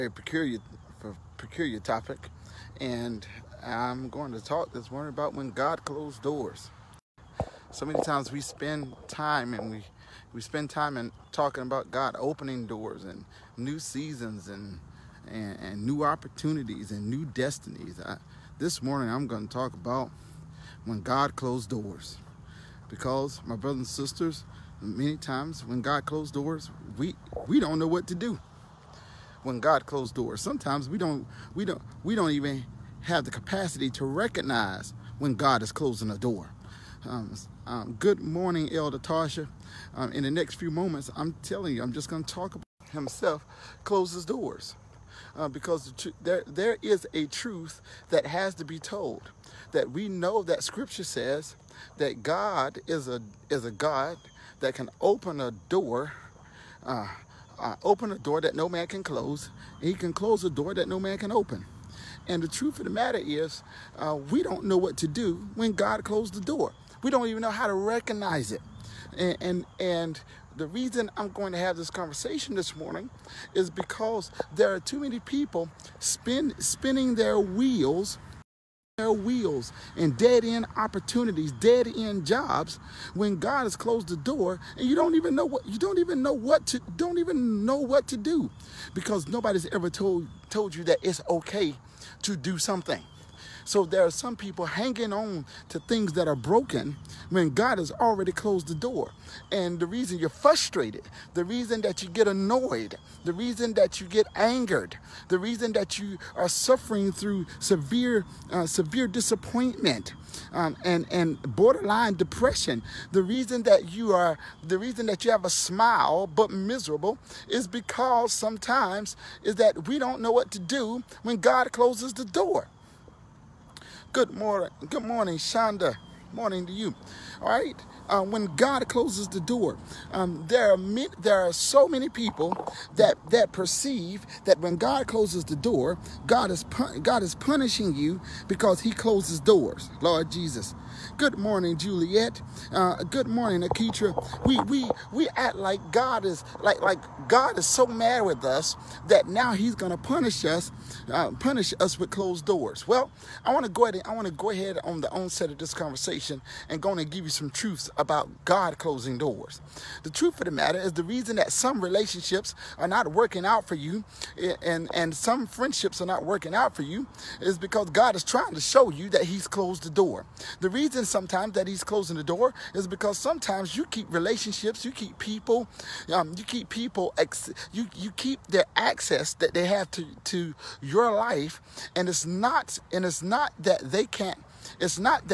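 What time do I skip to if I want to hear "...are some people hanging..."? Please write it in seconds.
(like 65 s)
94 s.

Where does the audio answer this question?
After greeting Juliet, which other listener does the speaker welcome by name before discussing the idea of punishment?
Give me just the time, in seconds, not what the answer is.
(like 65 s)
143 s.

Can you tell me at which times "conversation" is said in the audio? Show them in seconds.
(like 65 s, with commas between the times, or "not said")
71 s, 155 s.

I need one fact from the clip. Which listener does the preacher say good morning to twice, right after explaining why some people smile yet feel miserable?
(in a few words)
Shonda.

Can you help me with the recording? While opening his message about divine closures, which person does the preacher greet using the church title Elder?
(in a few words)
Elder Tasha.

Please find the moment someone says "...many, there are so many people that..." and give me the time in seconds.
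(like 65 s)
130 s.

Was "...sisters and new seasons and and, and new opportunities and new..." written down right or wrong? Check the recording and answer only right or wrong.
wrong.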